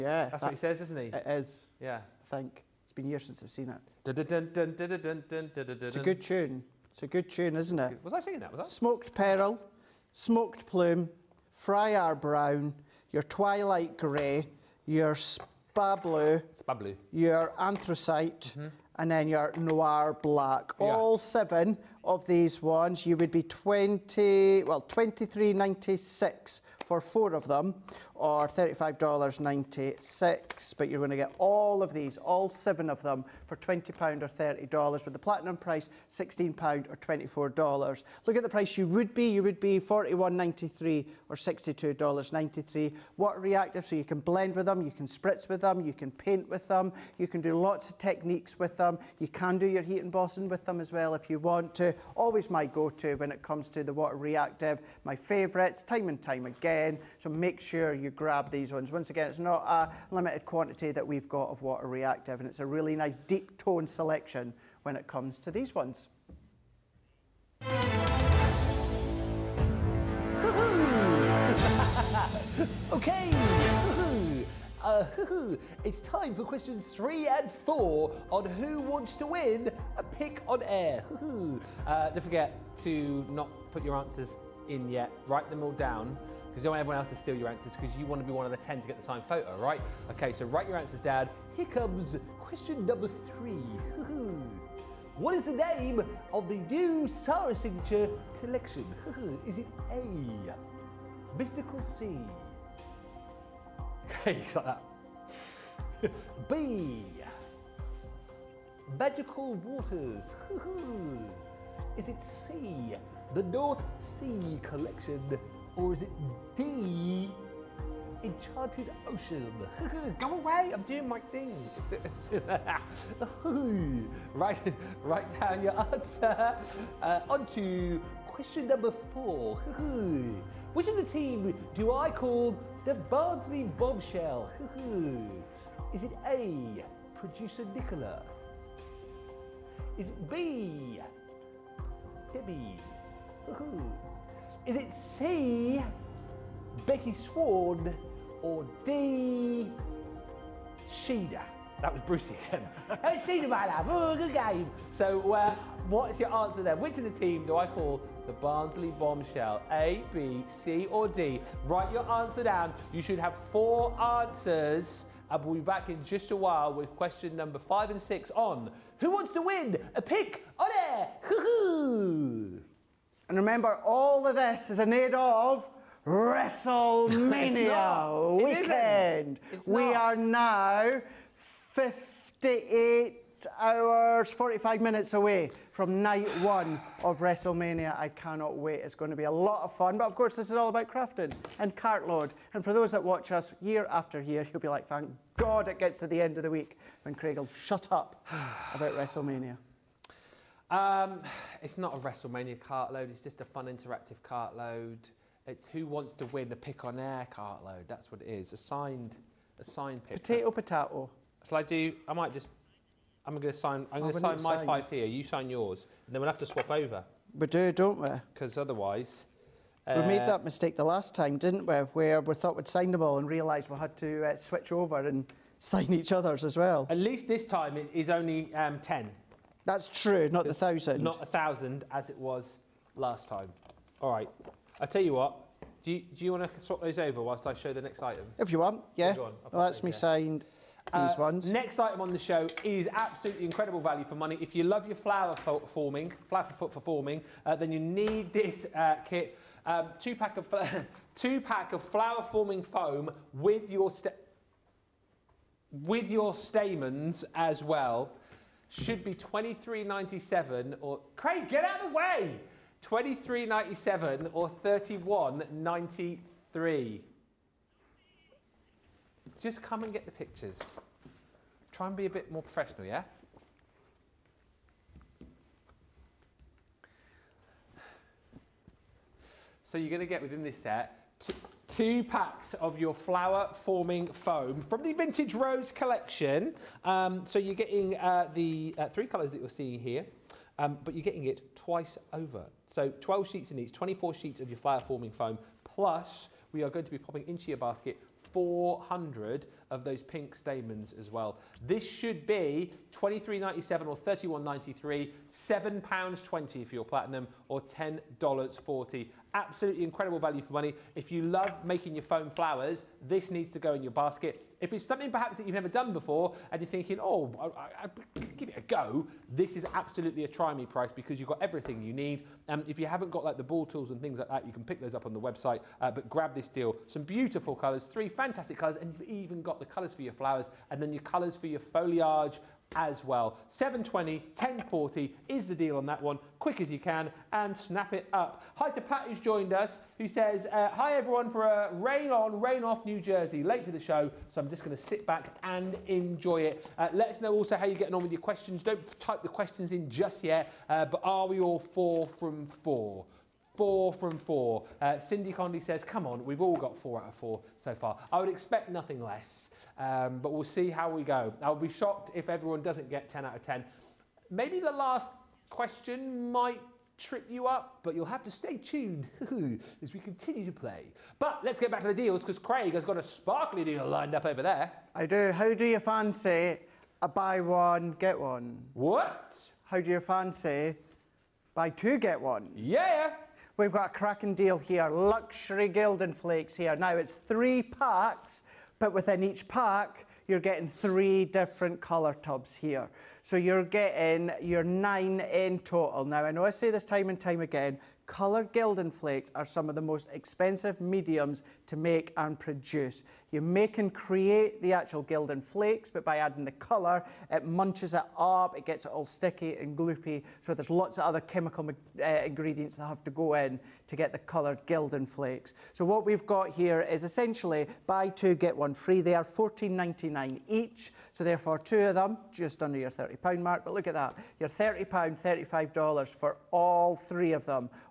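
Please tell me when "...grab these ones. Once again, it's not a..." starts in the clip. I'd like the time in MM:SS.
00:58.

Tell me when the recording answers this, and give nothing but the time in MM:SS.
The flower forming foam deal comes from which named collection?
04:44.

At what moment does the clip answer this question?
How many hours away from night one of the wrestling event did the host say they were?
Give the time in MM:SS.
03:01.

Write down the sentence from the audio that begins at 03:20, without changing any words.
Um, it's not a WrestleMania cartload.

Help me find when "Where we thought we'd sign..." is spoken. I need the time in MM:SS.
03:41.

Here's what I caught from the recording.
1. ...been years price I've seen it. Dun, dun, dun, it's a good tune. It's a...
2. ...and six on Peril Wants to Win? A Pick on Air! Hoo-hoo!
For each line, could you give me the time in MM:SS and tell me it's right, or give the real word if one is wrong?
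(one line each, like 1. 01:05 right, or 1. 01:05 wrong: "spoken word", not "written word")
1. 00:02 wrong: "since", not "price"
2. 02:47 wrong: "Who", not "Peril".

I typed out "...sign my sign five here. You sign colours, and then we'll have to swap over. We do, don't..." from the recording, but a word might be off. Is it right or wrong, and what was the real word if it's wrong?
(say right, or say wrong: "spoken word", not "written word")
wrong: "yours", not "colours".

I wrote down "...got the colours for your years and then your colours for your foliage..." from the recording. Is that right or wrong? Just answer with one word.
wrong.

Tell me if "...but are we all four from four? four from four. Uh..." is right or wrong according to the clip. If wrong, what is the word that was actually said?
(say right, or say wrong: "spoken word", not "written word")
right.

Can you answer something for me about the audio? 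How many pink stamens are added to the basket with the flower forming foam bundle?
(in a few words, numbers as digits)
400.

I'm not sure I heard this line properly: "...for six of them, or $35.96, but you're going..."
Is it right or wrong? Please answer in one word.
wrong.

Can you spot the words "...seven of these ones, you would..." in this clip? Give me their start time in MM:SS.
00:21.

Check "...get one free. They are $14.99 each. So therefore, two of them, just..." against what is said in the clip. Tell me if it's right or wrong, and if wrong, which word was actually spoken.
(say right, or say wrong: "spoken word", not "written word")
right.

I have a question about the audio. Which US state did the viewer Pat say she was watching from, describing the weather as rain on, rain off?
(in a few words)
New Jersey.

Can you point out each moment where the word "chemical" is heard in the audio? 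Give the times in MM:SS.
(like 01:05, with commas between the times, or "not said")
06:51.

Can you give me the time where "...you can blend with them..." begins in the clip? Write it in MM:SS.
00:43.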